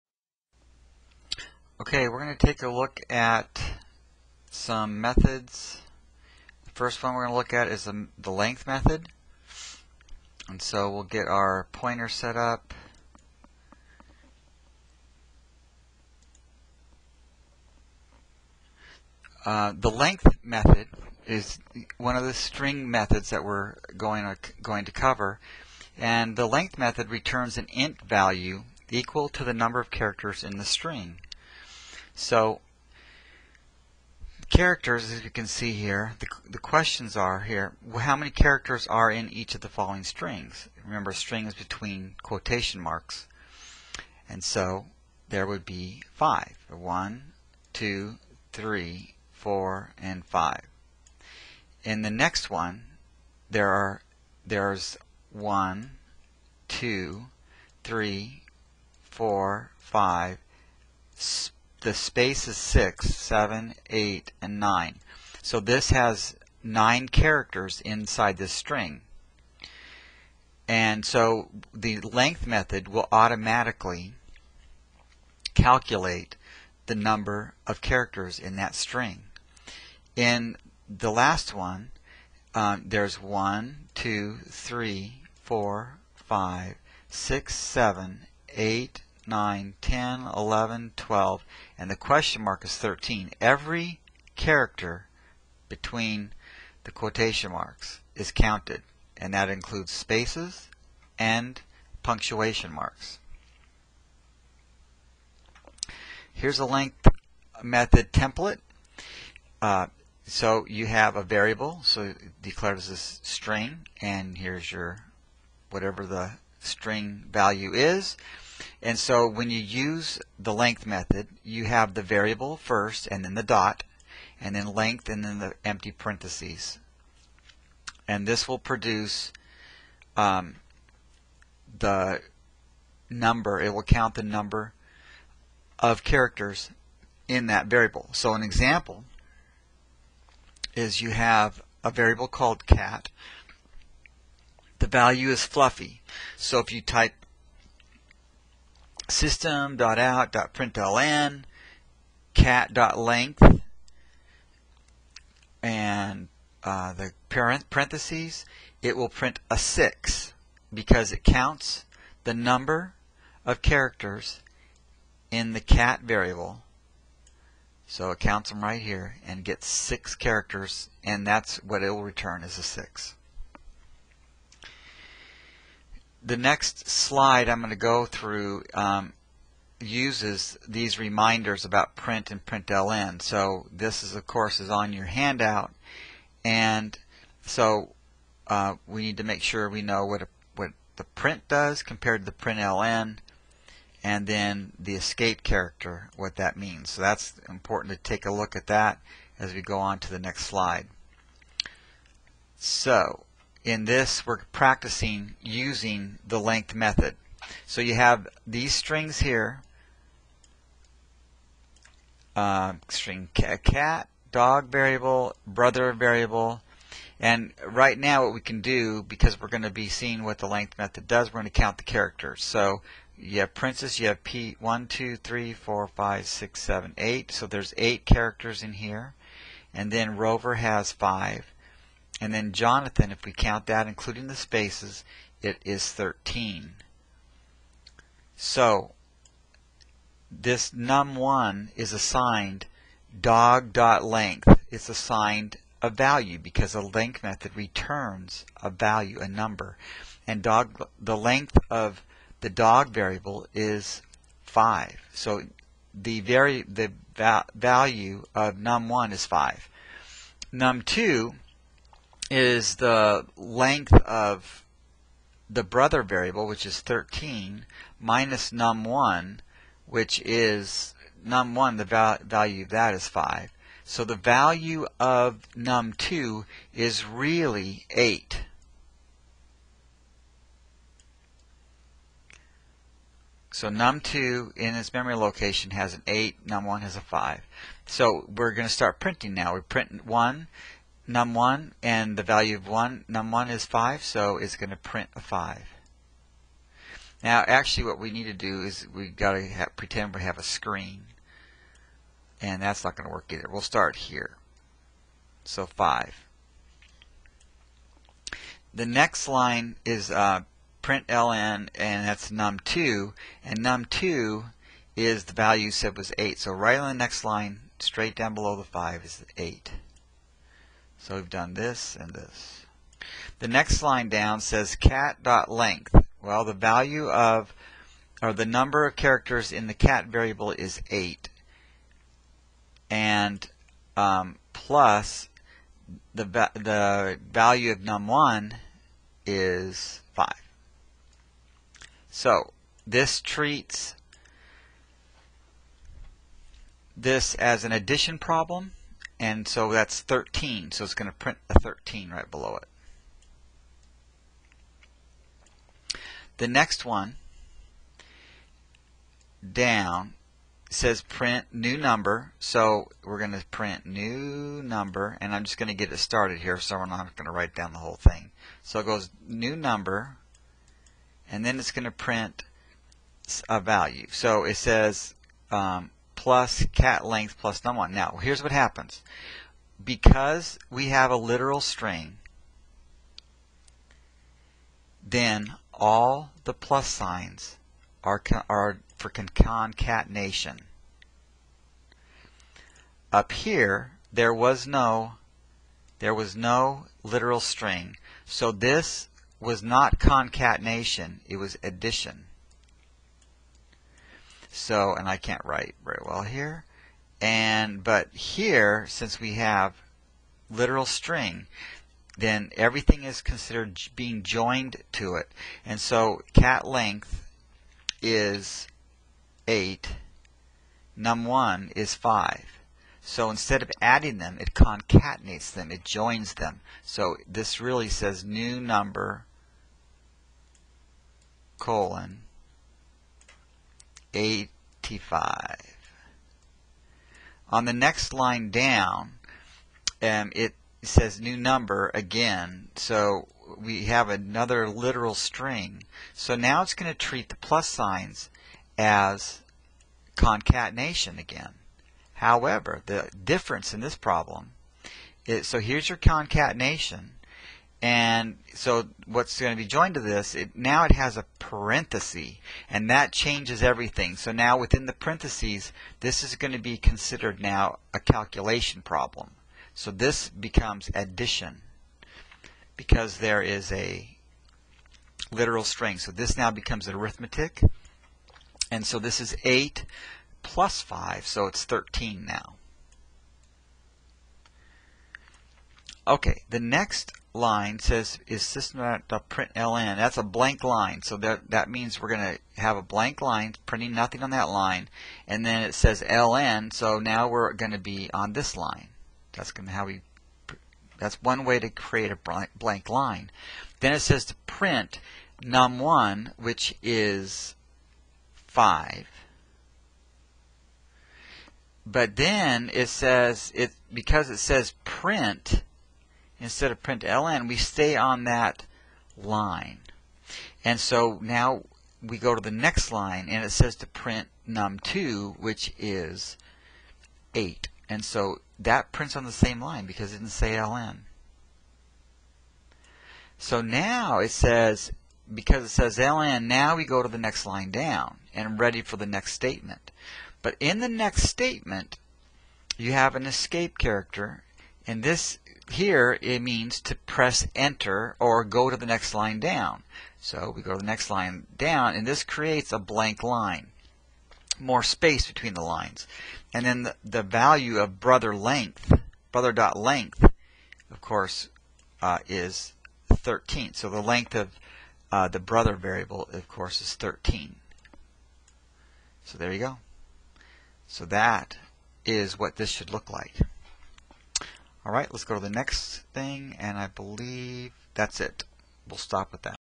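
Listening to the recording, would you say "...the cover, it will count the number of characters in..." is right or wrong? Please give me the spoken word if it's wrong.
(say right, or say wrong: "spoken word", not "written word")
wrong: "number", not "cover".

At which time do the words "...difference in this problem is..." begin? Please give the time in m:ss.
7:33.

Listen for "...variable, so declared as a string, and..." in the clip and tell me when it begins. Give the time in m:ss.
1:51.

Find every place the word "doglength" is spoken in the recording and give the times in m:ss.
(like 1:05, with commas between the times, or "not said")
4:03.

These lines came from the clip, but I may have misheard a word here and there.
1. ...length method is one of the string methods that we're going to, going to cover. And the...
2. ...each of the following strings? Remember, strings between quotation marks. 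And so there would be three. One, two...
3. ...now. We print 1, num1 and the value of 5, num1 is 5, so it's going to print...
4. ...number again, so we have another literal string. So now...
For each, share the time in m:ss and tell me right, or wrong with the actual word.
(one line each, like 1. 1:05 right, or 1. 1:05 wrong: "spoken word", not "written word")
1. 0:19 right
2. 0:39 wrong: "five", not "three"
3. 4:49 wrong: "1", not "5"
4. 7:21 right.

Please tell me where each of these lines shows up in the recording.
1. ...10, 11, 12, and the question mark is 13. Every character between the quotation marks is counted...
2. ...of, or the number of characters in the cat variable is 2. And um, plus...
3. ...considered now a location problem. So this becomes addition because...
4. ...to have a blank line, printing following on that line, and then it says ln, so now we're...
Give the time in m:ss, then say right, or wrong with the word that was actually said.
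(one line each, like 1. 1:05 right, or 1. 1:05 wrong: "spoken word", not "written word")
1. 1:29 right
2. 5:27 wrong: "8", not "2"
3. 7:46 wrong: "calculation", not "location"
4. 8:12 wrong: "nothing", not "following".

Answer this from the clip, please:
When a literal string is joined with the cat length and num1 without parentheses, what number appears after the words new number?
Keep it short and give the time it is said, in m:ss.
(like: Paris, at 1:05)
85, at 7:14.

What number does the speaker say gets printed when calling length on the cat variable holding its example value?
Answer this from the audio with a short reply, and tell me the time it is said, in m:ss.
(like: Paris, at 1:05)
6, at 2:38.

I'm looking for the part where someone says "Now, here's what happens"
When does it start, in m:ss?
6:17.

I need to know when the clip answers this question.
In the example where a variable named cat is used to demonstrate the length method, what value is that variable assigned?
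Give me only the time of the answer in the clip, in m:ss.
2:25.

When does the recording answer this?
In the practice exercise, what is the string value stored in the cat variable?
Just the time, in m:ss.
3:43.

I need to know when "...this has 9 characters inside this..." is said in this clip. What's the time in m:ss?
1:05.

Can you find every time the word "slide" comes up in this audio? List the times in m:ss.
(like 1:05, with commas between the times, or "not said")
2:56, 3:20.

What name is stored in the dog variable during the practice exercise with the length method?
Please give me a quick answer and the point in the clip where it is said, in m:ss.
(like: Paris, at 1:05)
Rover, at 3:50.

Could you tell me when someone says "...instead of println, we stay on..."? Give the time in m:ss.
8:36.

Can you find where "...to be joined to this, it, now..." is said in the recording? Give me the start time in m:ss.
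7:39.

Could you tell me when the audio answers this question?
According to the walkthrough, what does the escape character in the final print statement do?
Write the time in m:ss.
9:06.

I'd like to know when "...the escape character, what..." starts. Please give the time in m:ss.
3:14.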